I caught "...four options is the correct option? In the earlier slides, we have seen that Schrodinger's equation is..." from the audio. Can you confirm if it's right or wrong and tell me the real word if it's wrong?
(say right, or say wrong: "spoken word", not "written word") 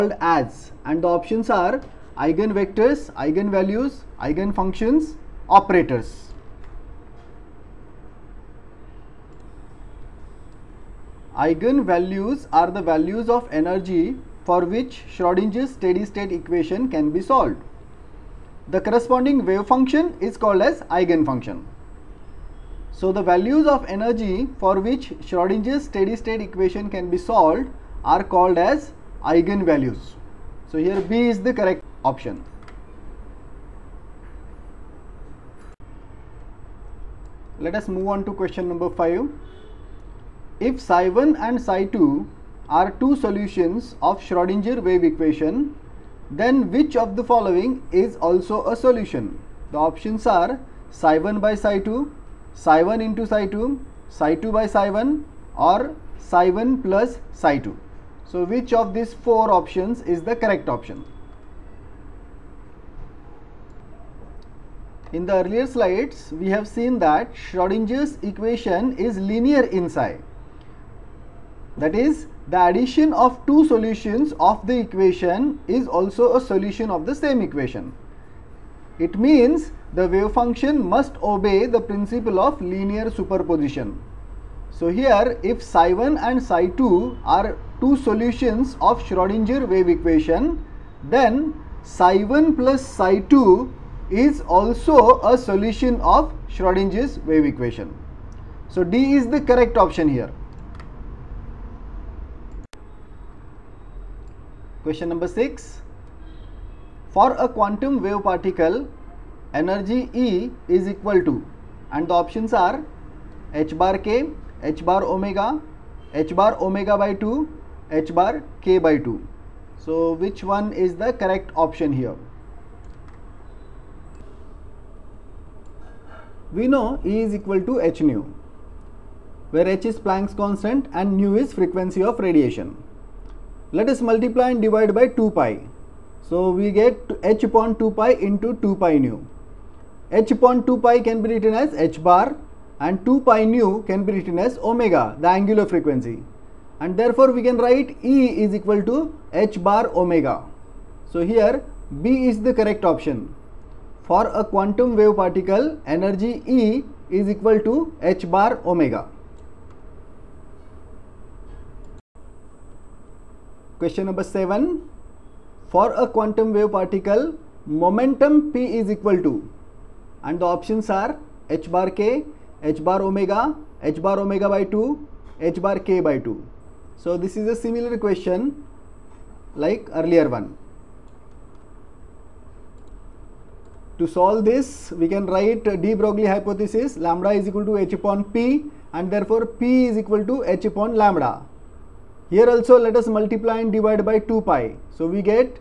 right.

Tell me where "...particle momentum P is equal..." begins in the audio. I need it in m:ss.
2:46.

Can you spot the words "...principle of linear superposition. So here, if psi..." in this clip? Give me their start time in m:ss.
1:21.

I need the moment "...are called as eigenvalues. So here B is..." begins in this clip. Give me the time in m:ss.
0:28.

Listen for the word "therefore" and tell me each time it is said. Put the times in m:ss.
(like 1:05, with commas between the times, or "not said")
2:26, 3:09.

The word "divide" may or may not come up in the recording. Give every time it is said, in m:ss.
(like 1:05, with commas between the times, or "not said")
2:14, 3:13.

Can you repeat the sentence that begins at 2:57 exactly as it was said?
So, this is a similar question like earlier one.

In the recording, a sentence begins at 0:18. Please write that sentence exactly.
The corresponding wave function is called as eigenfunction.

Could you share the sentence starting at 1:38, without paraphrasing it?
So D is the correct option here.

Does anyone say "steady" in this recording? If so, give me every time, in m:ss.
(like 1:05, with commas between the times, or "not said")
0:15, 0:25.